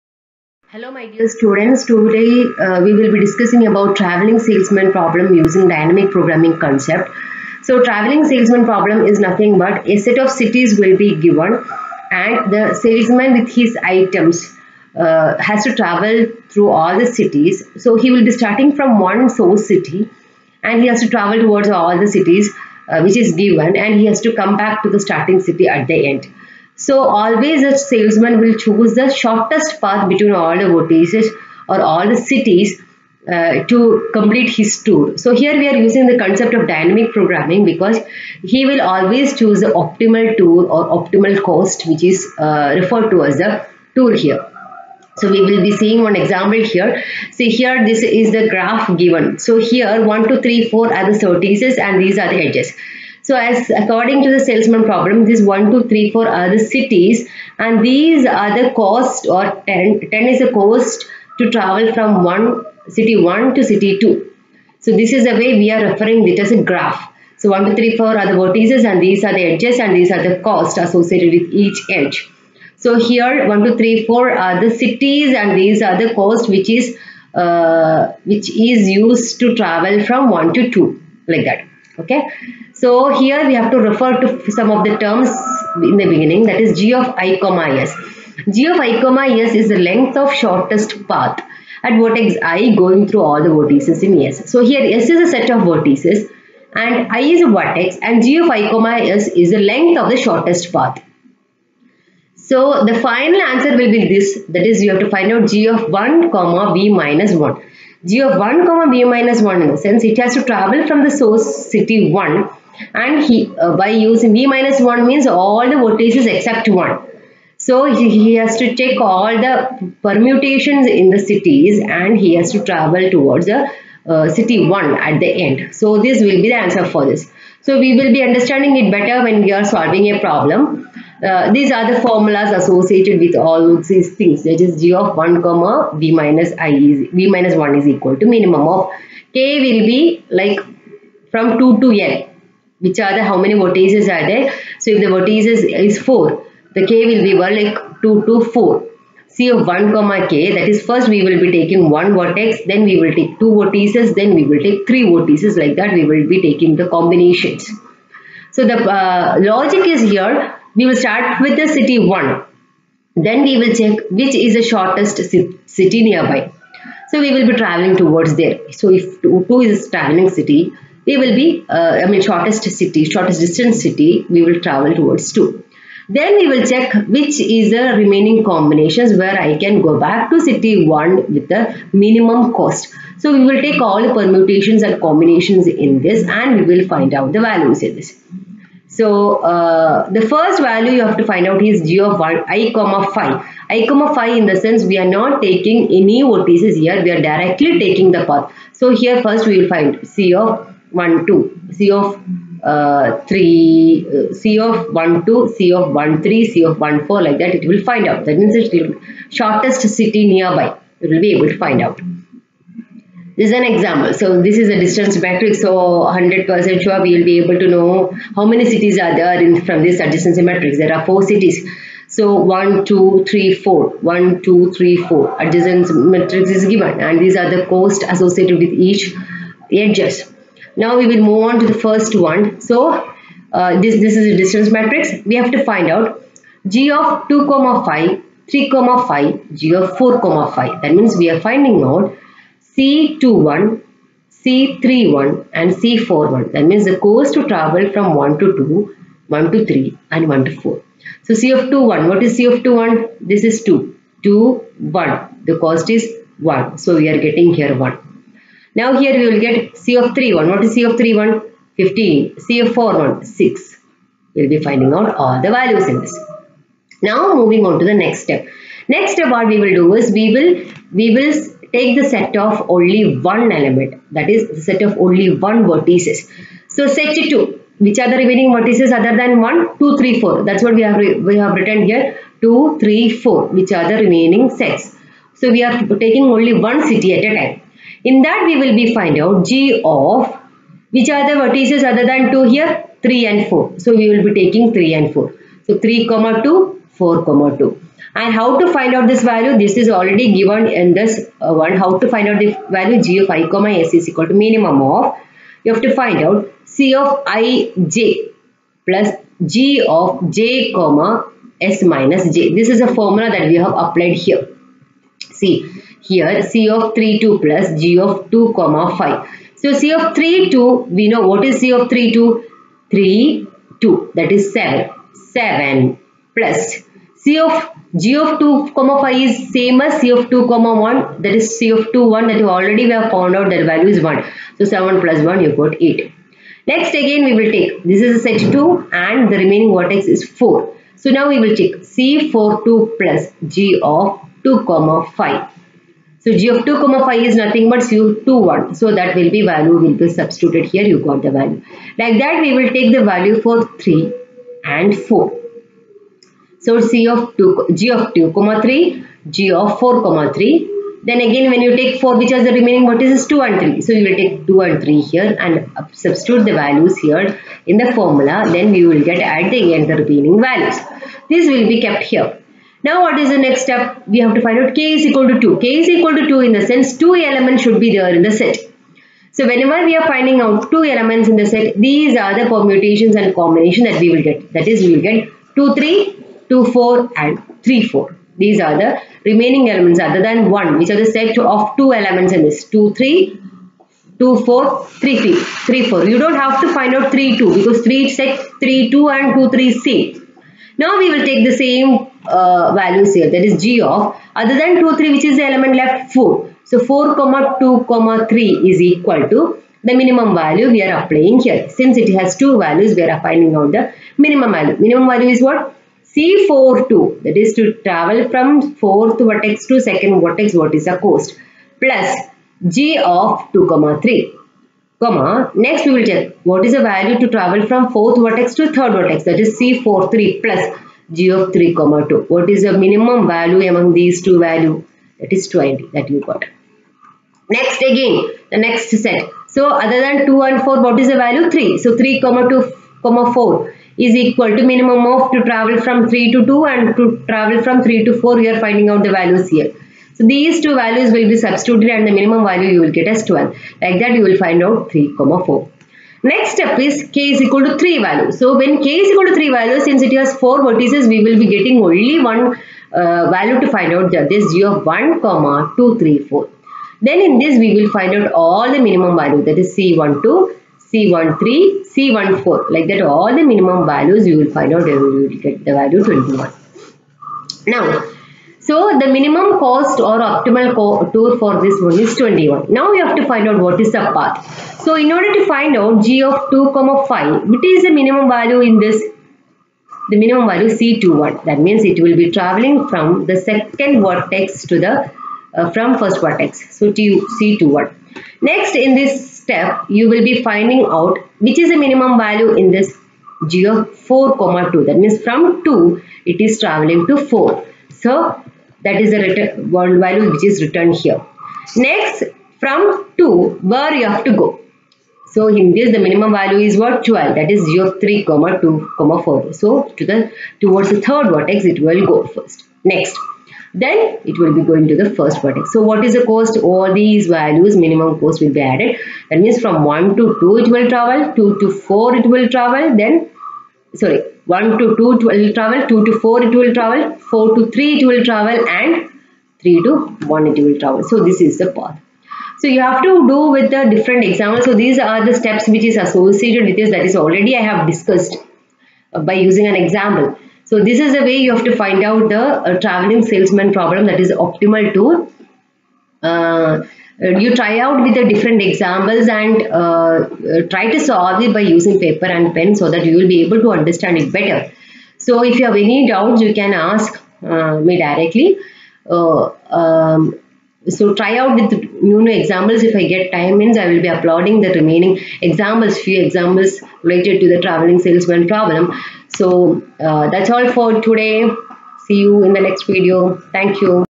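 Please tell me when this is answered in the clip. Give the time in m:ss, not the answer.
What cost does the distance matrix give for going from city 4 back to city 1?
4:23.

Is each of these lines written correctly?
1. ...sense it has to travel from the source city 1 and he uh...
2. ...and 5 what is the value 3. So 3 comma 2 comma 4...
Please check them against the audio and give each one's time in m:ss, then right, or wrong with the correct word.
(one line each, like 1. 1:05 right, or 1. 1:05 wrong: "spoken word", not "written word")
1. 1:49 right
2. 7:20 wrong: "4", not "5".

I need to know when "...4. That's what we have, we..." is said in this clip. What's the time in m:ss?
4:40.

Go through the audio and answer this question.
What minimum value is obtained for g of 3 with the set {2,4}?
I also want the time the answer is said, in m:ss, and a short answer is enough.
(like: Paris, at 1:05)
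12, at 7:32.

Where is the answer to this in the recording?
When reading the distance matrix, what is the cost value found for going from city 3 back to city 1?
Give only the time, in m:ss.
4:21.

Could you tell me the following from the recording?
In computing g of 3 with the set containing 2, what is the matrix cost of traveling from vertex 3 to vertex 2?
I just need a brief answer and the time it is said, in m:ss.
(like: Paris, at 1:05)
7, at 5:24.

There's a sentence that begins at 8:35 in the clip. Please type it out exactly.
So in this the minimum value is what 12 that is 0, 3 comma 2 comma 4.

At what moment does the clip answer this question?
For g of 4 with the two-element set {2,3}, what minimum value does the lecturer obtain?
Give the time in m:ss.
7:15.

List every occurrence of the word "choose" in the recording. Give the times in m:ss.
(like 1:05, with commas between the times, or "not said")
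0:28, 0:39.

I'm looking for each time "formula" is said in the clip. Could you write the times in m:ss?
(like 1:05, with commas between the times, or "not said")
2:12, 5:13, 6:07.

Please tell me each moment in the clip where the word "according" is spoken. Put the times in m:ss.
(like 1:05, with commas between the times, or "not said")
0:53.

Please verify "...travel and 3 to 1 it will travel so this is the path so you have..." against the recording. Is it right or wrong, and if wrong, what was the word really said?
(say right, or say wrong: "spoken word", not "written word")
right.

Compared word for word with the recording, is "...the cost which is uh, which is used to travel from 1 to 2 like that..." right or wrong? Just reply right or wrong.
right.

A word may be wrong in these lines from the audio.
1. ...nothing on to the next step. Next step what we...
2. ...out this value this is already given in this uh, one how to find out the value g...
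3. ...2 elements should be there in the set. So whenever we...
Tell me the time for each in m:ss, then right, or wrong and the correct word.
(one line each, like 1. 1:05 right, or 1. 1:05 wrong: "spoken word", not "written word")
1. 4:27 wrong: "moving", not "nothing"
2. 4:58 right
3. 6:16 right.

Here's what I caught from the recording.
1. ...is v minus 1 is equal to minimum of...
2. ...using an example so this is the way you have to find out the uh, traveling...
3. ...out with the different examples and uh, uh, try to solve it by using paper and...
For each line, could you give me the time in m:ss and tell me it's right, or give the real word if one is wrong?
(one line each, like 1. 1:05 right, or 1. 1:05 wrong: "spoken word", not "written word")
1. 2:16 right
2. 9:09 right
3. 9:17 right.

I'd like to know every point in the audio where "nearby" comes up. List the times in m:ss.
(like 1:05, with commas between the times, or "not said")
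2:46, 3:30.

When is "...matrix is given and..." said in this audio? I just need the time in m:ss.
3:46.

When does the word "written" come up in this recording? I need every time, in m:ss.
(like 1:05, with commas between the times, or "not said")
4:41.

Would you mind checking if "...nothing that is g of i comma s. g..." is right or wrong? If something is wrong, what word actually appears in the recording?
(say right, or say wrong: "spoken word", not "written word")
wrong: "beginning", not "nothing".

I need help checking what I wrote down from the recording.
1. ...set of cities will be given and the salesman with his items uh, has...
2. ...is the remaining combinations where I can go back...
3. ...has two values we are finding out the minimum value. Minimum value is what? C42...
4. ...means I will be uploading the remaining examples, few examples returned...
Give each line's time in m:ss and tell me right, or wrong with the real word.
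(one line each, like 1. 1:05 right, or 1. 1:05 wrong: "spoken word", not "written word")
1. 0:09 right
2. 2:57 right
3. 6:52 right
4. 9:33 wrong: "related", not "returned".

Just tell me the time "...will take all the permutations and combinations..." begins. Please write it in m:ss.
3:03.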